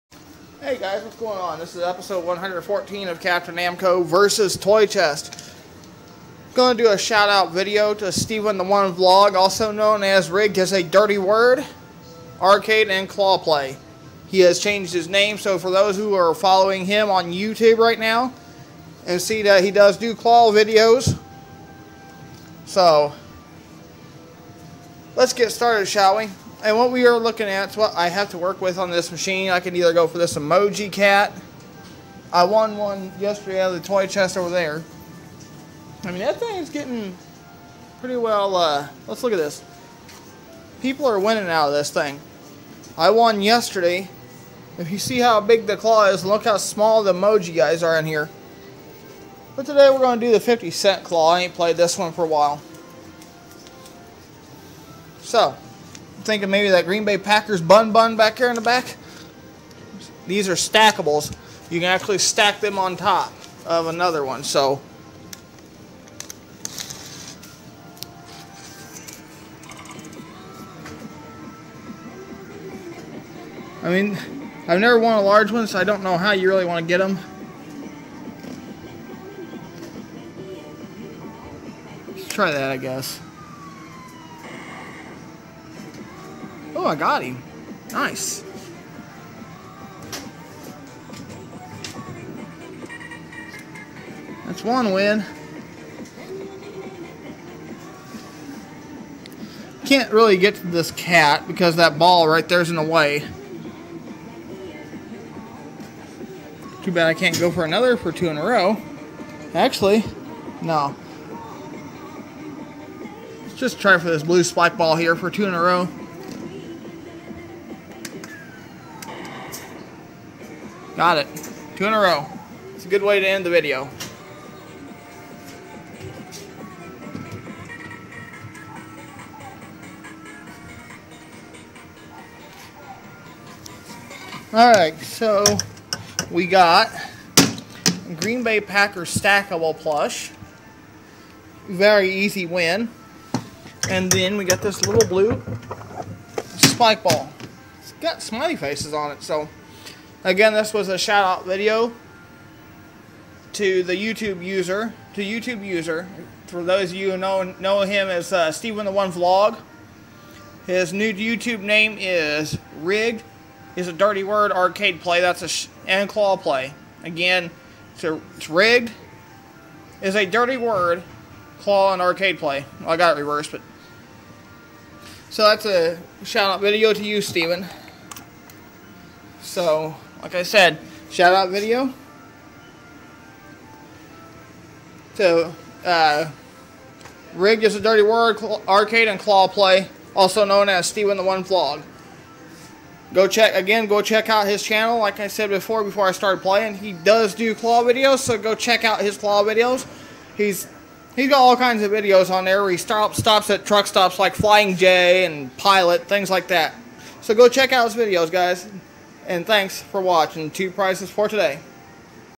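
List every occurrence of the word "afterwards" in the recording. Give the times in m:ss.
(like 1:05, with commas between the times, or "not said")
not said.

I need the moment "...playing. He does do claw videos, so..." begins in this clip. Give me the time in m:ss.
3:16.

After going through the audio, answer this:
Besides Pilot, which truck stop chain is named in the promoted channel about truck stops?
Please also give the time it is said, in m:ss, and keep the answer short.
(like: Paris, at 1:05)
Flying J, at 3:24.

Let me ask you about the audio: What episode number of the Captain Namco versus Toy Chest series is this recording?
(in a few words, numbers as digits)
114.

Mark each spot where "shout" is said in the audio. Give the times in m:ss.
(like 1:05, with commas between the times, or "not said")
0:06, 2:30, 2:56, 3:01.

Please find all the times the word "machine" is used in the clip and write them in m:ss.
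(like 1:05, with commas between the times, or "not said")
0:29.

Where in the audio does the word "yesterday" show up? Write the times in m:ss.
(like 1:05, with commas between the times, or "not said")
0:33, 0:43.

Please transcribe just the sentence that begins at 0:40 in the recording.
People are winning out of this thing.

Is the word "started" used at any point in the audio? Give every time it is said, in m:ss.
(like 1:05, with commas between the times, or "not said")
0:25, 3:16.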